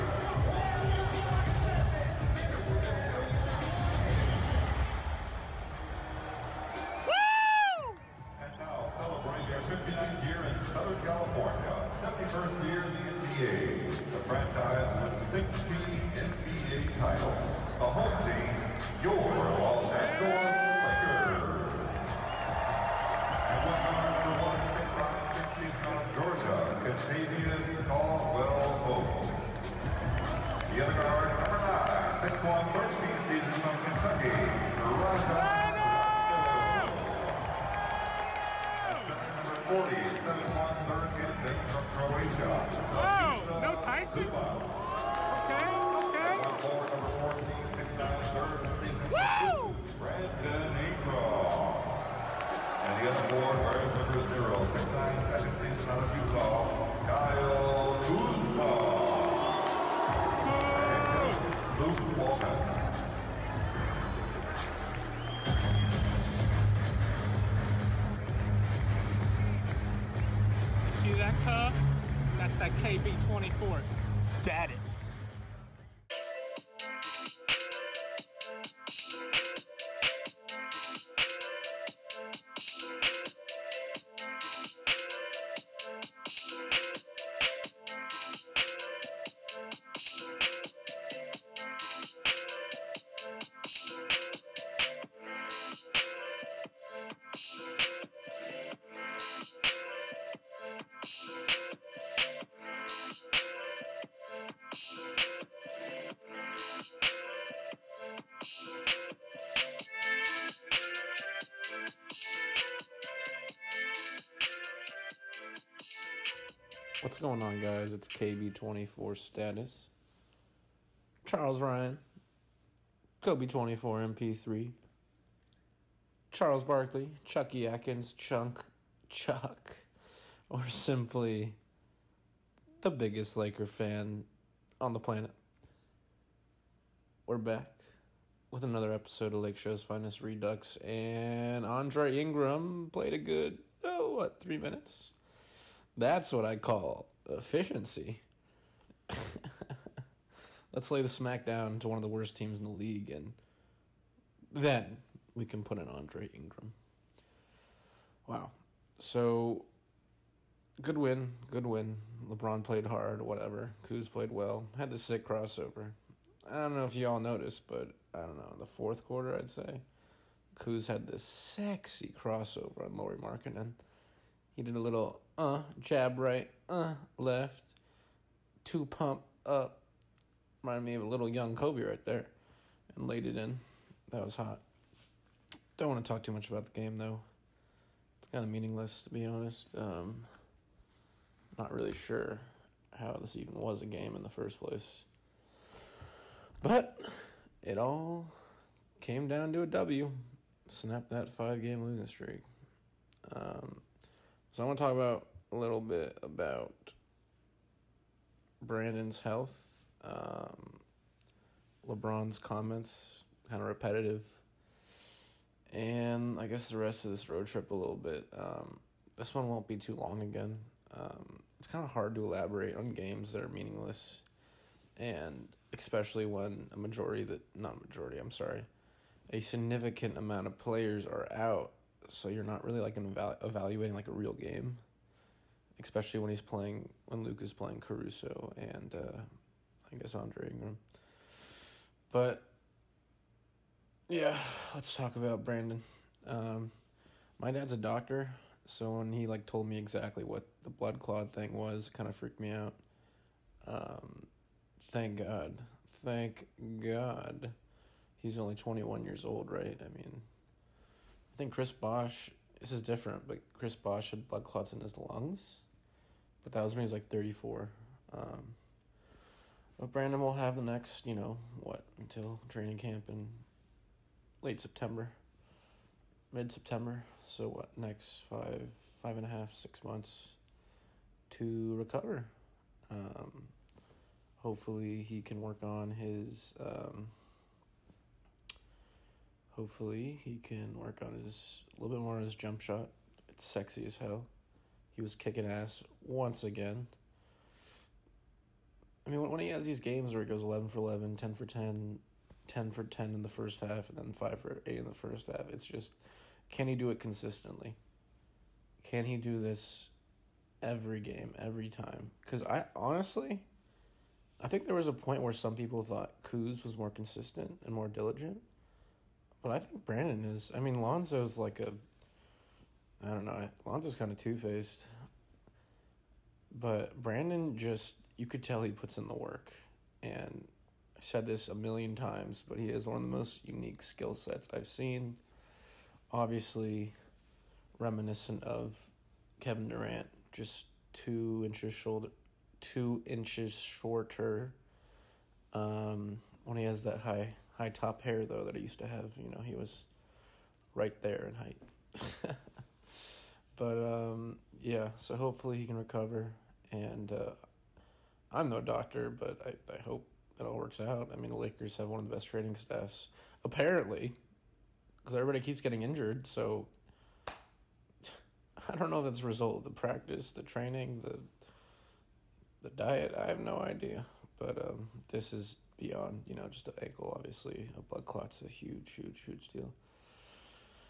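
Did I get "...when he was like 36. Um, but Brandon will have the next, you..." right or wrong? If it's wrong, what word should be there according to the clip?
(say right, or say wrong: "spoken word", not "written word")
wrong: "34", not "36".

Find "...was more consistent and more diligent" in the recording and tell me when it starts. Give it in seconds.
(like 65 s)
316 s.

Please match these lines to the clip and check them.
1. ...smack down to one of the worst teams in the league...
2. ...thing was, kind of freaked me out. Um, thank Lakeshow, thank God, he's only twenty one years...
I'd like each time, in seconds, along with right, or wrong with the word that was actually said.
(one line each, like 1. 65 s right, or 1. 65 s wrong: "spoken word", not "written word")
1. 151 s right
2. 251 s wrong: "God", not "Lakeshow".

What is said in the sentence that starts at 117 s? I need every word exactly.
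It's KB24 Status, Charles Ryan, Kobe24 MP3, Charles Barkley, Chucky Atkins, Chunk, Chuck, or simply the biggest Laker fan on the planet.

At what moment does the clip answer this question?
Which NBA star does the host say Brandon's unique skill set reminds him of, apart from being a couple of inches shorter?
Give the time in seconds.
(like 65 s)
339 s.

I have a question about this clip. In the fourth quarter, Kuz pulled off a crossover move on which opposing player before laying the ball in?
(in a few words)
Lauri Markkanen.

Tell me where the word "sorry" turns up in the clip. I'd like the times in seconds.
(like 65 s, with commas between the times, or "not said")
228 s.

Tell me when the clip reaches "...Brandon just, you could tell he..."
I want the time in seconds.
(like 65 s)
326 s.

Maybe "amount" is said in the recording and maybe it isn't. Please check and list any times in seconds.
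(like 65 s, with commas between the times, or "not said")
230 s.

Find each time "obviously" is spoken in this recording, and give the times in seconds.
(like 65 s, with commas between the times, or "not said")
336 s, 377 s.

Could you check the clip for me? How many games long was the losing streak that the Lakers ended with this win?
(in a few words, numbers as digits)
5.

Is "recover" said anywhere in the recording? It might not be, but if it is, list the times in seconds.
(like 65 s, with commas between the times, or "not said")
281 s, 355 s.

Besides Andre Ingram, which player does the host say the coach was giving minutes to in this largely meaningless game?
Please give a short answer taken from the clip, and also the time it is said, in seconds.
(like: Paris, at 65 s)
Caruso, at 237 s.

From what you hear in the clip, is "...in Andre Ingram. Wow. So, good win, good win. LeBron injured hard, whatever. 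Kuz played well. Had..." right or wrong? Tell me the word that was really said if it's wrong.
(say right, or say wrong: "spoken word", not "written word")
wrong: "played", not "injured".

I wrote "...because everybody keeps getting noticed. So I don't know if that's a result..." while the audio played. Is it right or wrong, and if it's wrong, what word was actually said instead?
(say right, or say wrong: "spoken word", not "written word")
wrong: "injured", not "noticed".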